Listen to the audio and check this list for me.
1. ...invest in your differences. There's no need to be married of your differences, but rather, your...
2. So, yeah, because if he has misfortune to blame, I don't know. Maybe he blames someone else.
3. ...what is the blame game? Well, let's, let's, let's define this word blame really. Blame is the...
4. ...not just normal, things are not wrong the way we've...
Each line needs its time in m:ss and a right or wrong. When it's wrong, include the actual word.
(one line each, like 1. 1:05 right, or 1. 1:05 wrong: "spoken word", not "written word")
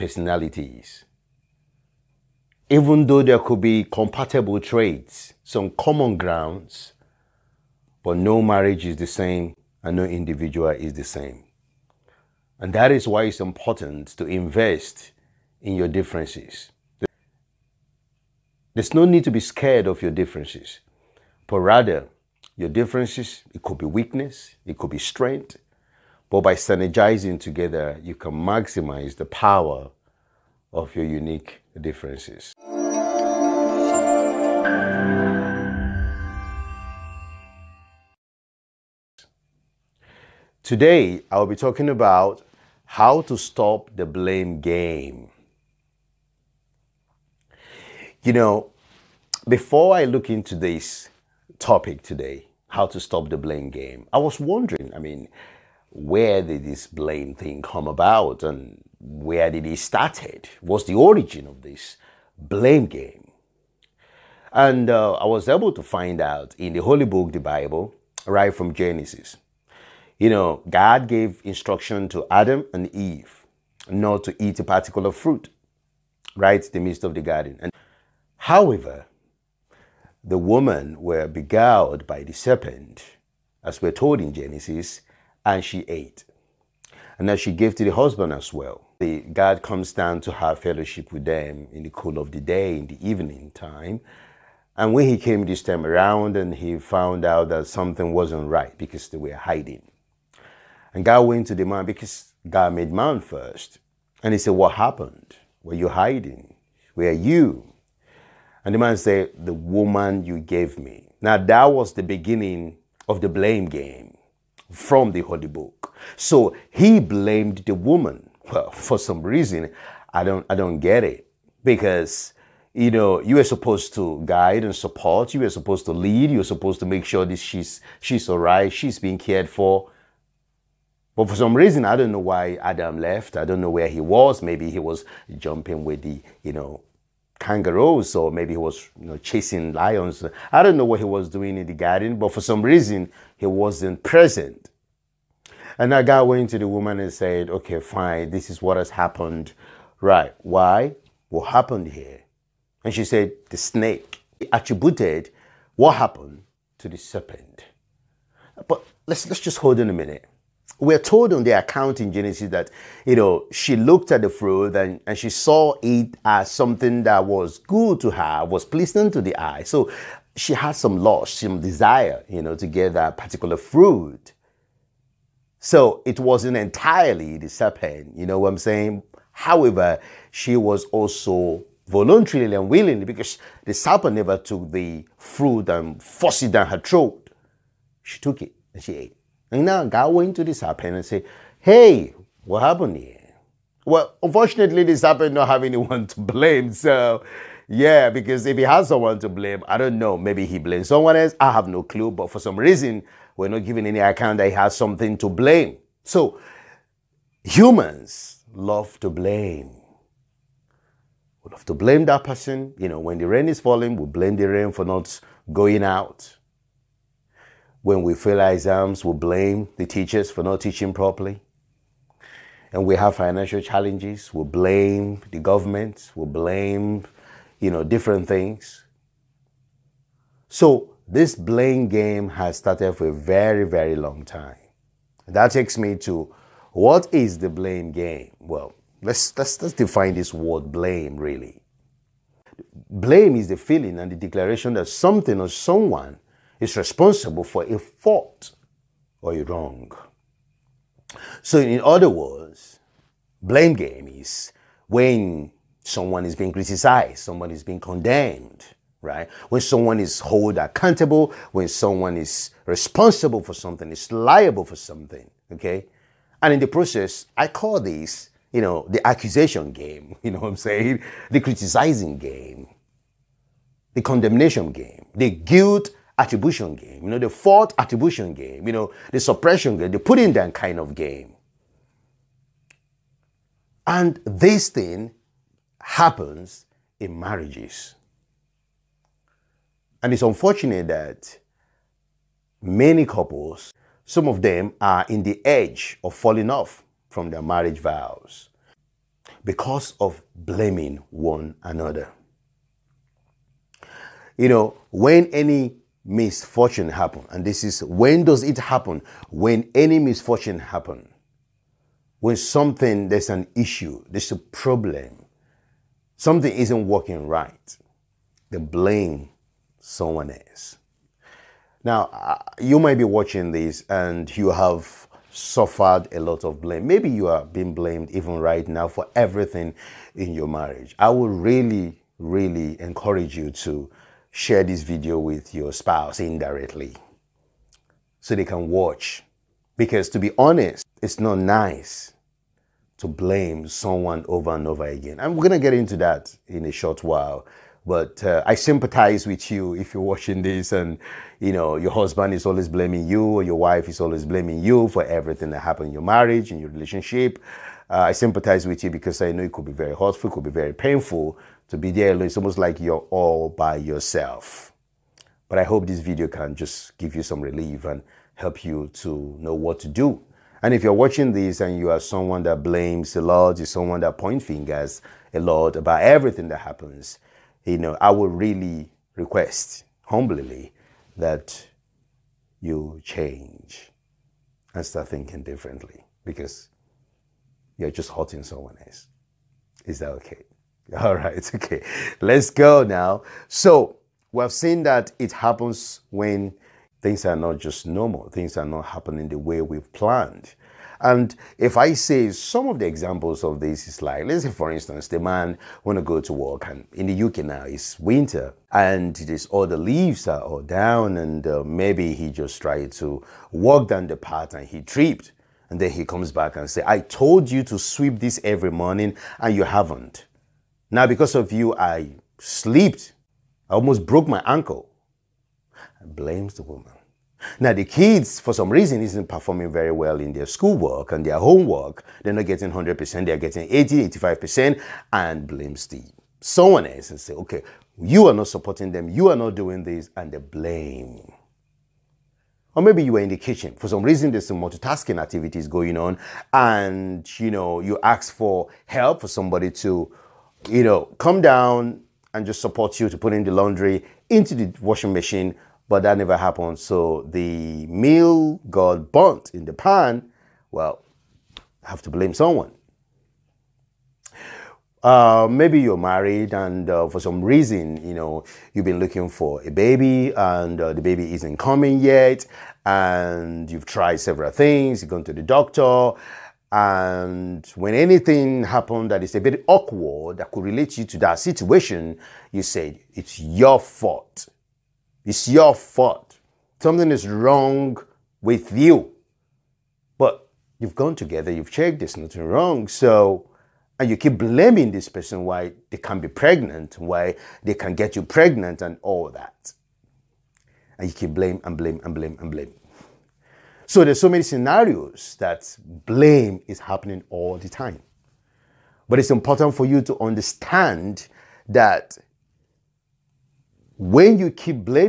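1. 0:14 wrong: "scared", not "married"
2. 3:16 wrong: "someone", not "misfortune"
3. 3:56 right
4. 6:37 wrong: "happening", not "wrong".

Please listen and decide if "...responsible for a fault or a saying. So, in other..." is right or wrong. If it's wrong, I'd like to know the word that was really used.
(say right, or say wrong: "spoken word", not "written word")
wrong: "wrong", not "saying".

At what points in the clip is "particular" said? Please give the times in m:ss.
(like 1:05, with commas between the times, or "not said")
1:14, 2:53.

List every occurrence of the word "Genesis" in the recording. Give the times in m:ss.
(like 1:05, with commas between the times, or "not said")
1:08, 1:24, 2:42.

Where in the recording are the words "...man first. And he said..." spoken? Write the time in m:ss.
1:42.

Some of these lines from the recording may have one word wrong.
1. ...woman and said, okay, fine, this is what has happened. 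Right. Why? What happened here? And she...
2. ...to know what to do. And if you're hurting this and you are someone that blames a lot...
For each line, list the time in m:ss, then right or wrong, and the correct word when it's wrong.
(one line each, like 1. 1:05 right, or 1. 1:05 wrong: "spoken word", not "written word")
1. 2:26 right
2. 6:08 wrong: "watching", not "hurting".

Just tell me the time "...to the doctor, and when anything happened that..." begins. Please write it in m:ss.
7:55.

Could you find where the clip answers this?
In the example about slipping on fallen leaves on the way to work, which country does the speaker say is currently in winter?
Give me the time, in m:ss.
6:47.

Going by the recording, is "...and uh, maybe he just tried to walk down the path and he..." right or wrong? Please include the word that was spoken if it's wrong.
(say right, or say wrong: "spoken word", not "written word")
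right.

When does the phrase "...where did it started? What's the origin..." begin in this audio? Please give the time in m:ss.
0:59.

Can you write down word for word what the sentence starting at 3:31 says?
We love to blame that person.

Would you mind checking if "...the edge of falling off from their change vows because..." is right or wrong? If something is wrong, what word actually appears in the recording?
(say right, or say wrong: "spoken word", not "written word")
wrong: "marriage", not "change".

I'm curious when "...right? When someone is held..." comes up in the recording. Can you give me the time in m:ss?
4:19.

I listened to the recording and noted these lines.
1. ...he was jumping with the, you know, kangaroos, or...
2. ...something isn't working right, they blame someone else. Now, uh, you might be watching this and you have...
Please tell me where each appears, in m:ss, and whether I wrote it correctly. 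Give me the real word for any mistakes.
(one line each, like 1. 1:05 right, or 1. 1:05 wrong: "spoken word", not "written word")
1. 2:14 right
2. 5:16 right.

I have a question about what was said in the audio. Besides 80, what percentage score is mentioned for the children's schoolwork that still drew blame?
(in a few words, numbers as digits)
85%.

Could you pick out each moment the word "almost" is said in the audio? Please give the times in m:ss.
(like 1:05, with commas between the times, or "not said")
6:02, 7:03.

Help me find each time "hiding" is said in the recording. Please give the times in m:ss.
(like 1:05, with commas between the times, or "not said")
1:39, 1:45.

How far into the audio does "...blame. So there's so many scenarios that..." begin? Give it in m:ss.
8:22.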